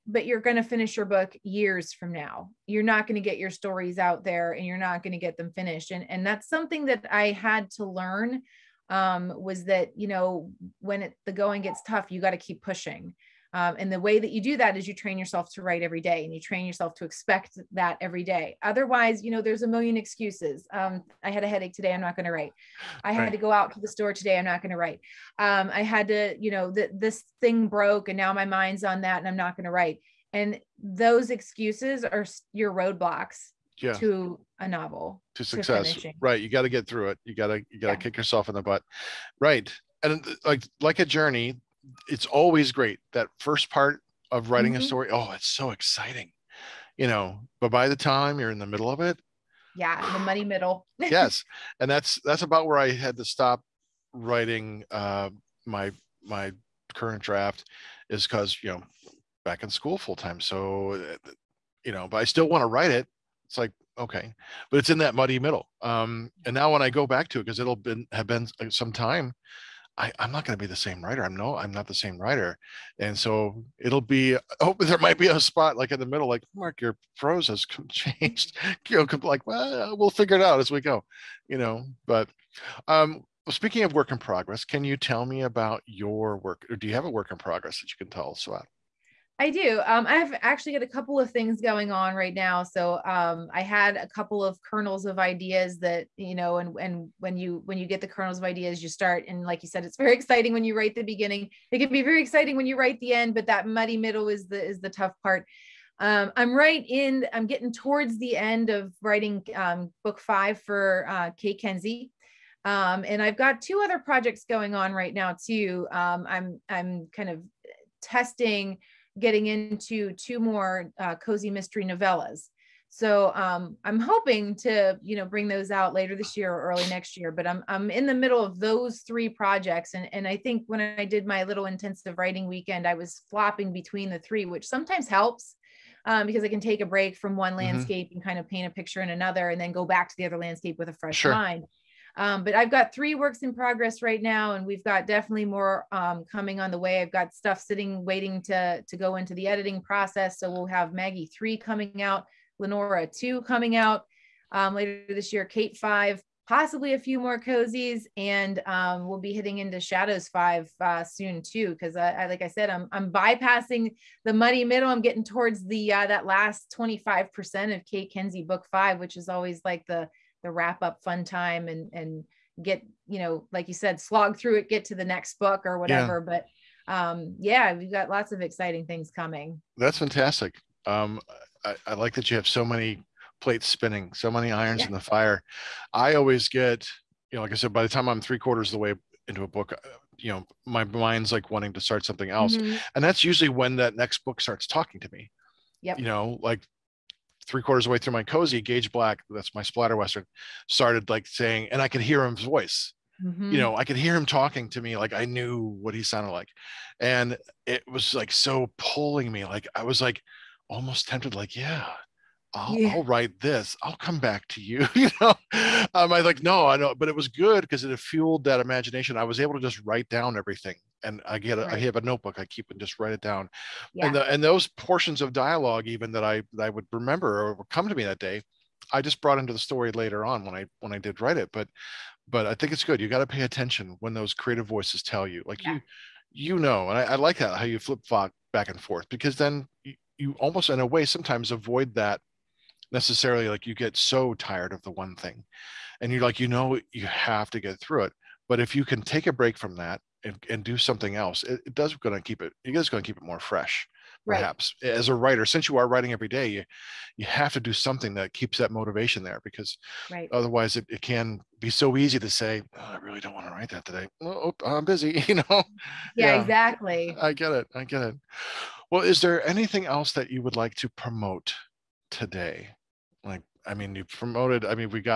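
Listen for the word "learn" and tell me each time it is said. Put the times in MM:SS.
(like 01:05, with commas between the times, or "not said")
00:07.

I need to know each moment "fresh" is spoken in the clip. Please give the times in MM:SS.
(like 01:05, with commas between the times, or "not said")
02:20, 04:13.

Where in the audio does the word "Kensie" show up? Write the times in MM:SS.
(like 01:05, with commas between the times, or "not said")
01:51, 02:48.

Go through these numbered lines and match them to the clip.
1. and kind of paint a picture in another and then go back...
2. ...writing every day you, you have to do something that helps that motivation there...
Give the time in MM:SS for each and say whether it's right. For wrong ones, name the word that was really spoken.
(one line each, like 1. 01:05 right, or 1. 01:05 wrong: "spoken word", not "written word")
1. 02:18 right
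2. 04:15 wrong: "keeps", not "helps".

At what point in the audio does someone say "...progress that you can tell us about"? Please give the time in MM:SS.
01:27.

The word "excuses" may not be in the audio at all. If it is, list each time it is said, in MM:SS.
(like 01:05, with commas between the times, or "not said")
00:19, 00:31.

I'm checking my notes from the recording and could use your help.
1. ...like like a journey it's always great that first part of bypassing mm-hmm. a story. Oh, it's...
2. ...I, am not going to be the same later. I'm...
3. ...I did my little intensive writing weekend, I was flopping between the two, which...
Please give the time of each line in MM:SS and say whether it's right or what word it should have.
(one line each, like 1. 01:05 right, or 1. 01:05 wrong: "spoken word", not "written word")
1. 00:40 wrong: "writing", not "bypassing"
2. 01:09 wrong: "writer", not "later"
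3. 02:10 wrong: "three", not "two".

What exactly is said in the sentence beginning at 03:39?
I was able to just write down everything and I get a, right.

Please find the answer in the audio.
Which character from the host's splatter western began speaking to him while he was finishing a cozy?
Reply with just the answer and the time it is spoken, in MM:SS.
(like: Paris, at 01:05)
Gage Black, at 03:18.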